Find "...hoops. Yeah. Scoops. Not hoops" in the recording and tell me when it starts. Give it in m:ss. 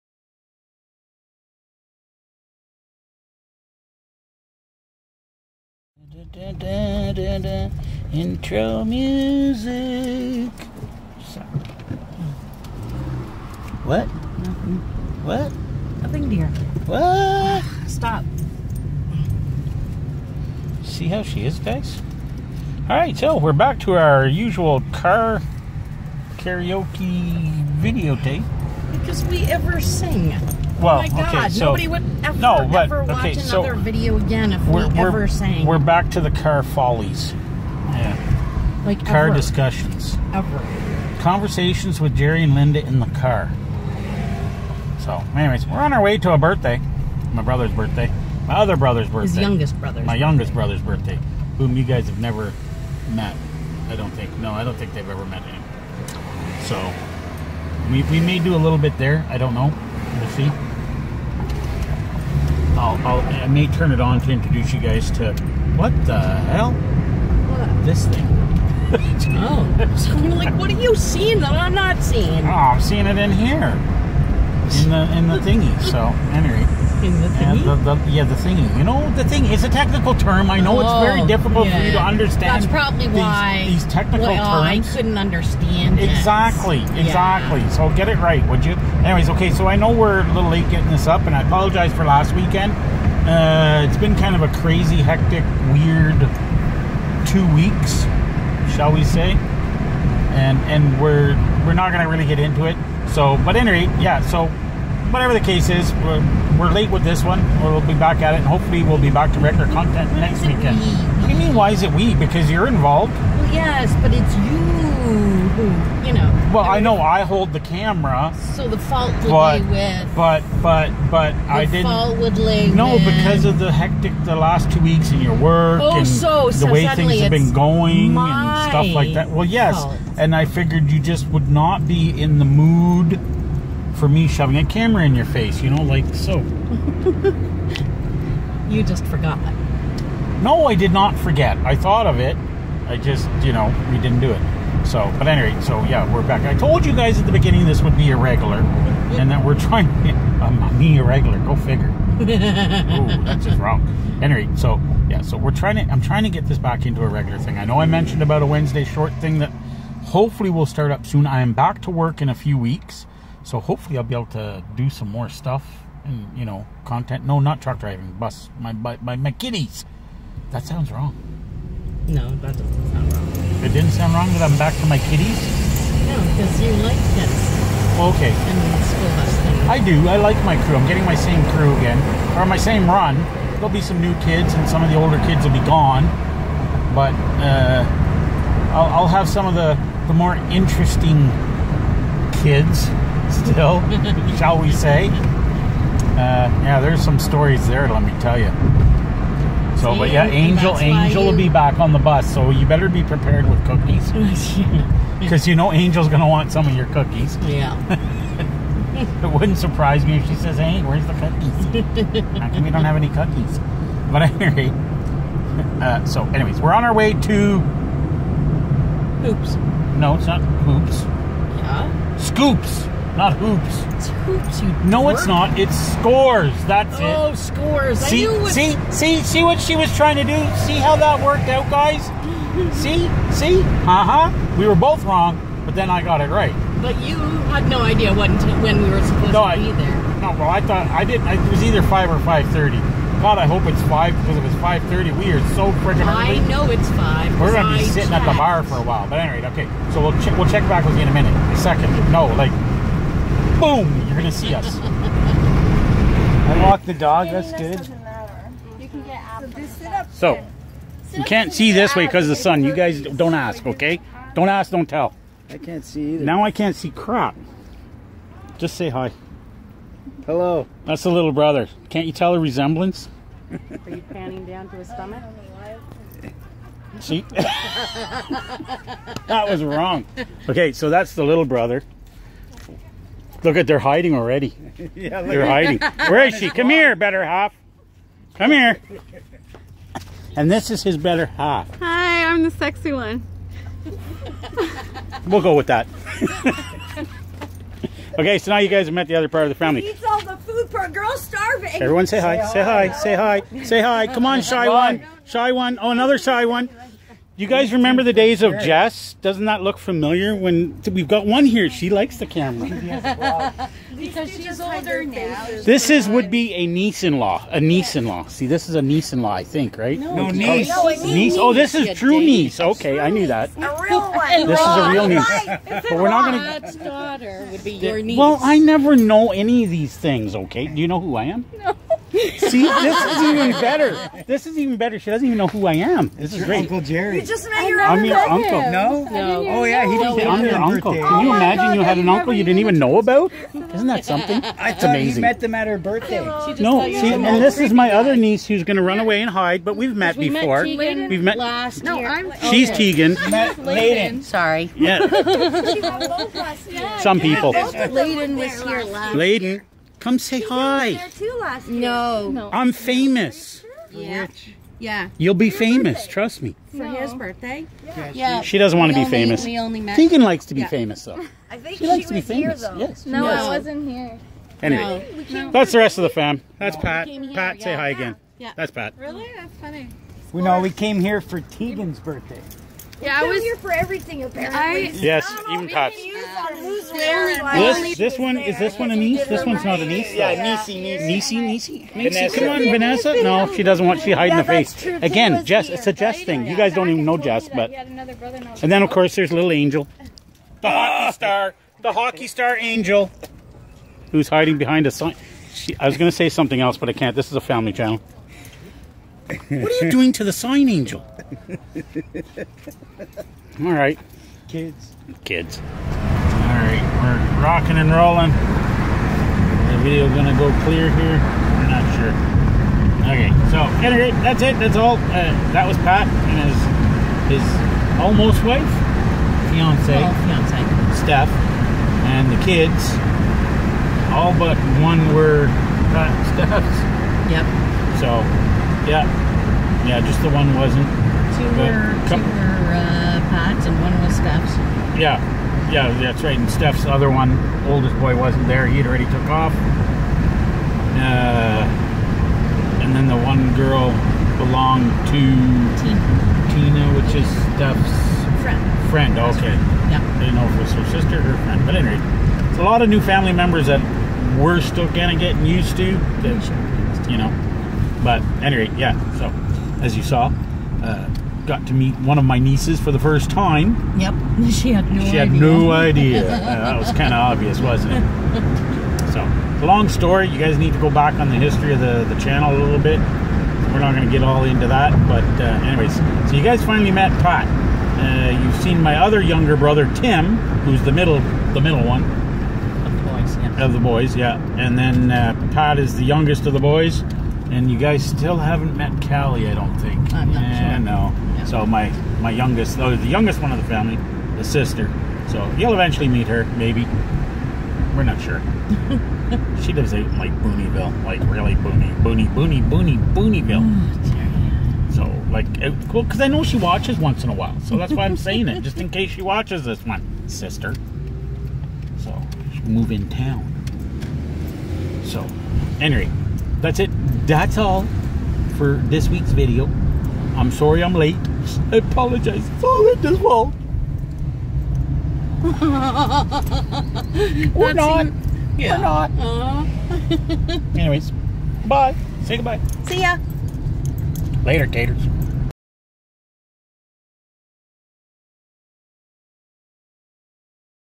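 3:40.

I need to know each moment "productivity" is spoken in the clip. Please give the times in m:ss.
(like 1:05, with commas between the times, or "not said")
not said.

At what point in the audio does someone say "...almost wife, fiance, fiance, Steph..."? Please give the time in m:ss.
7:07.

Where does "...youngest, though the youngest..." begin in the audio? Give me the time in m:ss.
8:22.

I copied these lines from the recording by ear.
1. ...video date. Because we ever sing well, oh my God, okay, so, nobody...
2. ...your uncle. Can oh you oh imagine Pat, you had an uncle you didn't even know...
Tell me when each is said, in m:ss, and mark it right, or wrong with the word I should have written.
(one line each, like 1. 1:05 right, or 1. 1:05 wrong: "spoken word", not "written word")
1. 0:27 right
2. 5:40 wrong: "God", not "Pat".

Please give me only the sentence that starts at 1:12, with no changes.
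Oh, I'm seeing it in here, in the in the thingy.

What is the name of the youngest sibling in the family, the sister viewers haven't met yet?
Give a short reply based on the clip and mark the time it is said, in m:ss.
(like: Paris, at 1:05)
Callie, at 8:19.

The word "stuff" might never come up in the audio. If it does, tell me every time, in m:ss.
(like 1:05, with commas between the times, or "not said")
2:08, 2:45.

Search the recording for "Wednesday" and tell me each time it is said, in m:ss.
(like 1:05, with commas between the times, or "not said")
2:38.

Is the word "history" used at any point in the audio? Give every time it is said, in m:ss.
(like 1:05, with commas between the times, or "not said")
8:01.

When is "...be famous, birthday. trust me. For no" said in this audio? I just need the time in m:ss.
6:05.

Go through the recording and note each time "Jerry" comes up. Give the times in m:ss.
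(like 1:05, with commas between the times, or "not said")
0:42, 5:36.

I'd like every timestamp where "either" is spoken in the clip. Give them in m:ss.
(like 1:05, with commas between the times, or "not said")
4:01, 4:26.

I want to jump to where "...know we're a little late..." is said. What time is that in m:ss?
1:29.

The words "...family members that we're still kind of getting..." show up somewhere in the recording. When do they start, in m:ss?
7:43.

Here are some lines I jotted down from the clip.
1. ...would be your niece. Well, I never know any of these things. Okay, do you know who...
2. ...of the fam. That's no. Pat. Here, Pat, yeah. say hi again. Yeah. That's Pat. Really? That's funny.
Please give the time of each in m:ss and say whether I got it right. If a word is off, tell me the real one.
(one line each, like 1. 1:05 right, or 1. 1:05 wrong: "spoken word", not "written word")
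1. 5:27 right
2. 6:15 right.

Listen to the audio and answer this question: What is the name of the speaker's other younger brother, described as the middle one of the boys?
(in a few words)
Tim.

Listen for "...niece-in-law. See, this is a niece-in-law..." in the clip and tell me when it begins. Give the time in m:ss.
5:17.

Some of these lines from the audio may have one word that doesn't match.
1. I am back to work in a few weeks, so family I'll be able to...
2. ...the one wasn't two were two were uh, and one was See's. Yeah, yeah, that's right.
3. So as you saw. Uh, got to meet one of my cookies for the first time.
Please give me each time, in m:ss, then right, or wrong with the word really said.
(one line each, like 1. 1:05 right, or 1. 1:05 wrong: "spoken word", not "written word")
1. 2:41 wrong: "hopefully", not "family"
2. 7:20 wrong: "Steph", not "See"
3. 7:49 wrong: "nieces", not "cookies".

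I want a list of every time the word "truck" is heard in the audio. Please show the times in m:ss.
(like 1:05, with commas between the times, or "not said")
2:47.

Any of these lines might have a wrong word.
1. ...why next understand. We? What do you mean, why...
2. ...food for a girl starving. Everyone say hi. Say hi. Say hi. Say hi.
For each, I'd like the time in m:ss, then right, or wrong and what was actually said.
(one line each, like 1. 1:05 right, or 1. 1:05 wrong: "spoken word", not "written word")
1. 1:50 wrong: "weekend", not "understand"
2. 5:00 right.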